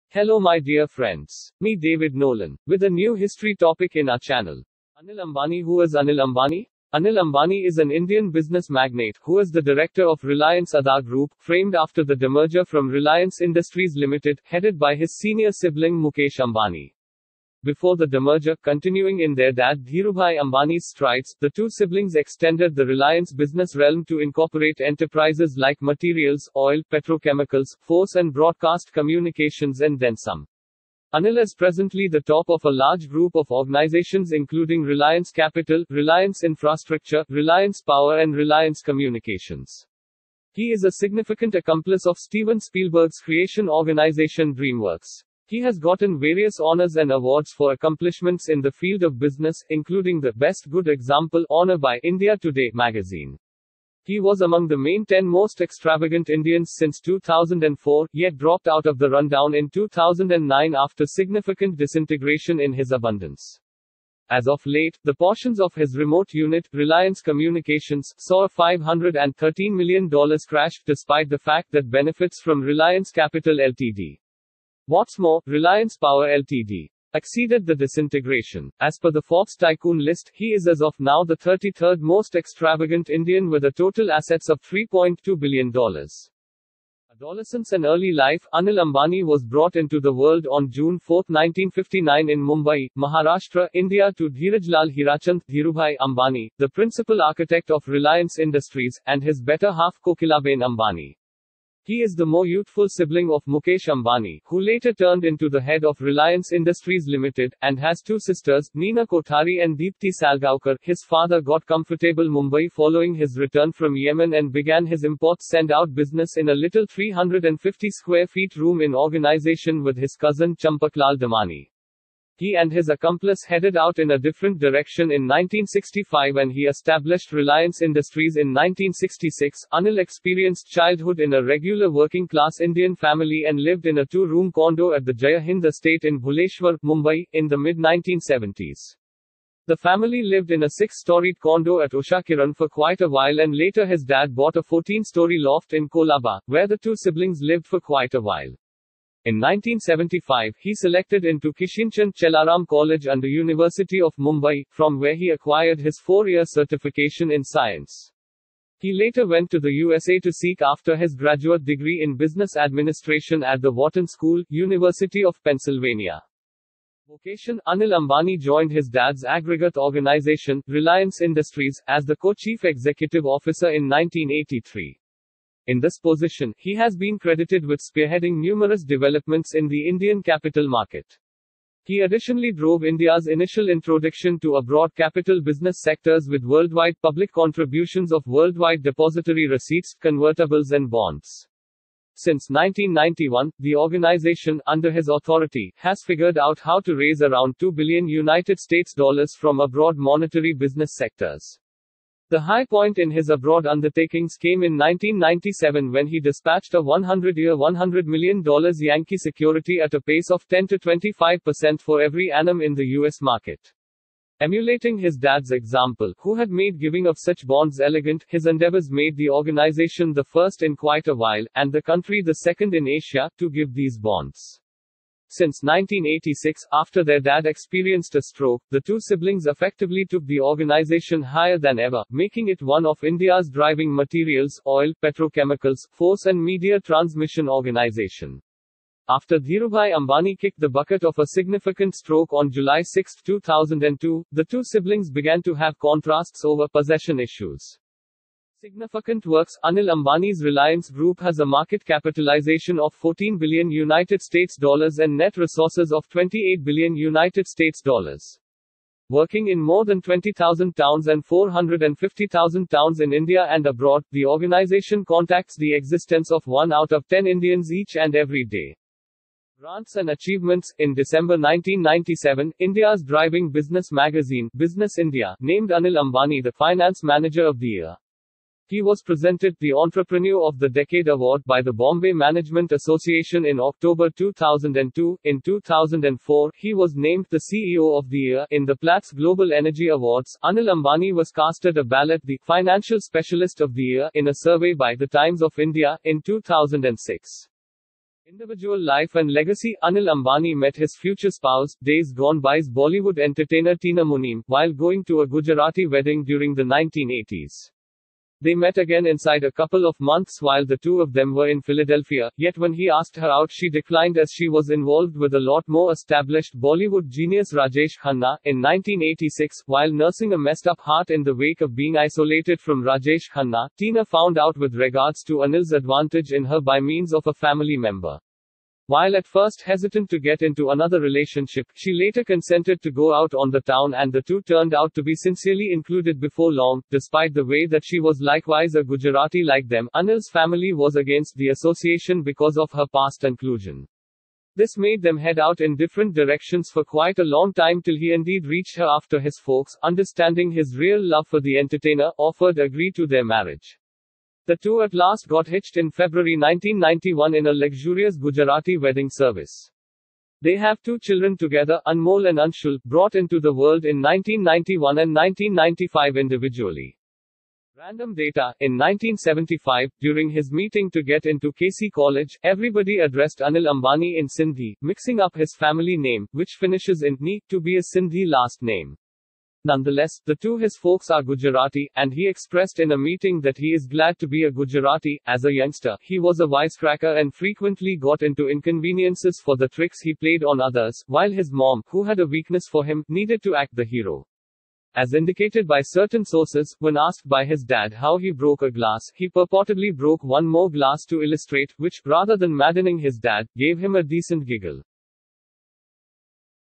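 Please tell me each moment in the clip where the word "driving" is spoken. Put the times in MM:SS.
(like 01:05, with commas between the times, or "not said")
03:53, 04:33.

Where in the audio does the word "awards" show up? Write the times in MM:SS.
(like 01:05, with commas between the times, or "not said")
00:47, 04:41, 04:49.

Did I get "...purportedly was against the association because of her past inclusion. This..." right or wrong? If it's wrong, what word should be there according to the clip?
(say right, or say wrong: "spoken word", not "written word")
wrong: "family", not "purportedly".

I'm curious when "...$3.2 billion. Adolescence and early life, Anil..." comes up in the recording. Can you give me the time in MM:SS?
01:24.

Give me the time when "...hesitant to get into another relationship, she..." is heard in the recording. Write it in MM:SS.
05:29.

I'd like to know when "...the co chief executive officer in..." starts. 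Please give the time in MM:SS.
02:52.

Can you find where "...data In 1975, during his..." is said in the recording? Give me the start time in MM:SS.
06:08.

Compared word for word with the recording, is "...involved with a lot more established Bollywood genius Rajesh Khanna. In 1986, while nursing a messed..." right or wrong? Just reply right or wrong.
right.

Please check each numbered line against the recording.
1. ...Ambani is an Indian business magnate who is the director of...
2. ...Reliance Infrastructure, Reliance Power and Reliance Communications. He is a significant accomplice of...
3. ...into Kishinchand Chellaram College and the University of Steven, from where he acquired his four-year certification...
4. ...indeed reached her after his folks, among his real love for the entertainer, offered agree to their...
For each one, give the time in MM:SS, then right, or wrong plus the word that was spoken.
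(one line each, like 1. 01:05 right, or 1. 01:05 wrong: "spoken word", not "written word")
1. 00:07 right
2. 00:35 right
3. 02:31 wrong: "Mumbai", not "Steven"
4. 05:48 wrong: "understanding", not "among".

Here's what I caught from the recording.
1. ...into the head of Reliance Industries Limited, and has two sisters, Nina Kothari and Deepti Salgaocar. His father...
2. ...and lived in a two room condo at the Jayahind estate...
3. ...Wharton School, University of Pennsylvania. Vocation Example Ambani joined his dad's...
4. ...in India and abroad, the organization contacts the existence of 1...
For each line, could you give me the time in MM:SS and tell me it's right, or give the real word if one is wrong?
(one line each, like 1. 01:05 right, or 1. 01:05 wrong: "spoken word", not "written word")
1. 01:45 right
2. 02:13 right
3. 02:43 wrong: "Anil", not "Example"
4. 04:22 right.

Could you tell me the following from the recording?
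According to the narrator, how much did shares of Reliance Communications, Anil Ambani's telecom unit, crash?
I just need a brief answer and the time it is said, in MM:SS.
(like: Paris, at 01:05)
$513 million, at 01:08.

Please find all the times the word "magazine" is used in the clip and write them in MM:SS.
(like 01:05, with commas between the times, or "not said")
00:52, 04:33.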